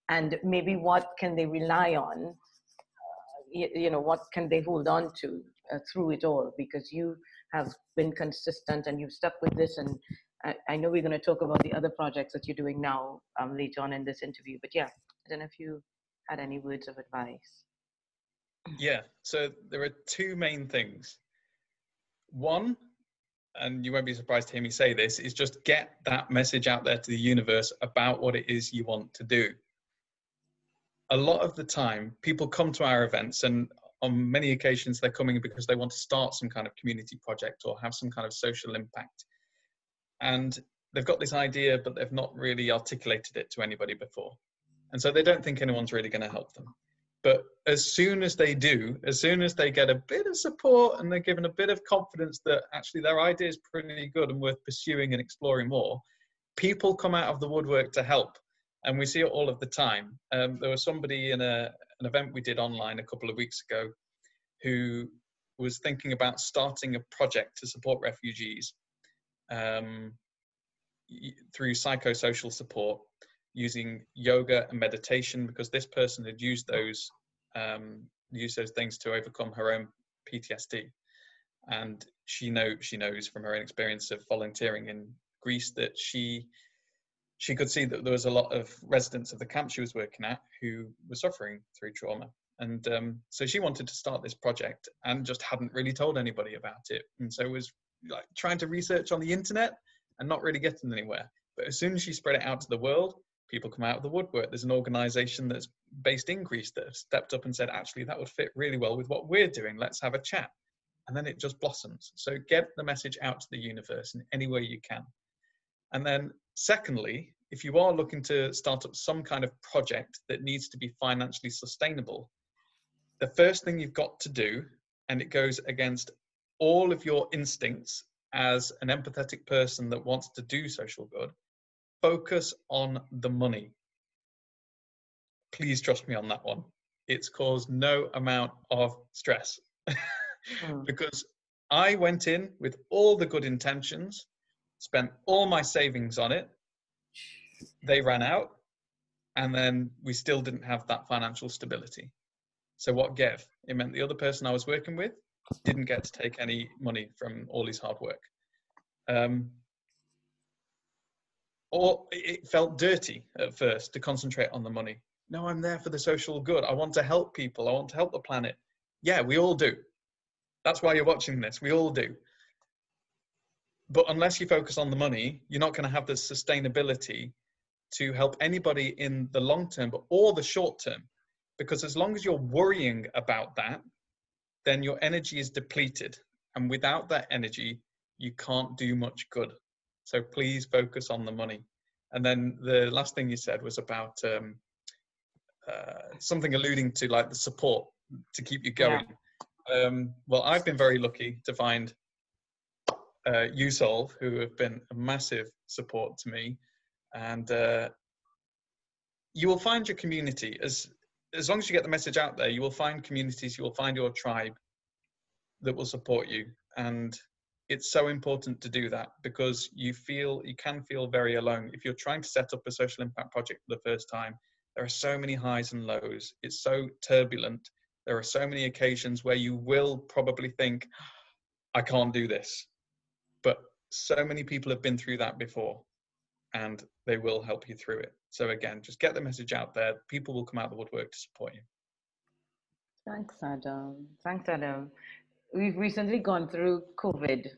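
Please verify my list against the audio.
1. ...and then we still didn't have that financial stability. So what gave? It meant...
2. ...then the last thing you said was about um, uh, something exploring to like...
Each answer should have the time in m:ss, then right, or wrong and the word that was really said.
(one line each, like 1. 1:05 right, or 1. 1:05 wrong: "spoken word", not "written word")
1. 2:29 right
2. 3:12 wrong: "alluding", not "exploring".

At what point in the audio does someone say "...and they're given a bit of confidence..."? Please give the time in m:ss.
0:51.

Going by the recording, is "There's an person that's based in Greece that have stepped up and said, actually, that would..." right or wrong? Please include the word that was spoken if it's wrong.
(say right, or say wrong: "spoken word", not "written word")
wrong: "organization", not "person".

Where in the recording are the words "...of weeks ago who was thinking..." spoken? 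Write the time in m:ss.
1:03.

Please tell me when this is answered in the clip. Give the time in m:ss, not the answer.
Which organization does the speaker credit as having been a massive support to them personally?
3:23.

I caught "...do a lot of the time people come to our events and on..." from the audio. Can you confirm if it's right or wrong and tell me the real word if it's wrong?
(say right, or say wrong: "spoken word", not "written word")
right.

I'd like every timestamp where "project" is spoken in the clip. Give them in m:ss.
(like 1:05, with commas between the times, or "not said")
0:11, 0:37, 1:07, 1:34, 1:59, 3:43.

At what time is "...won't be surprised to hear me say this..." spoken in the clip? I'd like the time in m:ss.
0:23.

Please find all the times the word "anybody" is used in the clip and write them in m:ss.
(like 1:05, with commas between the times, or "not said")
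0:43, 1:36, 2:58.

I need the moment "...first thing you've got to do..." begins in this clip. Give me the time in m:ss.
2:03.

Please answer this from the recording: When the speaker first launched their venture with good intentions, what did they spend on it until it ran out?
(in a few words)
all my savings.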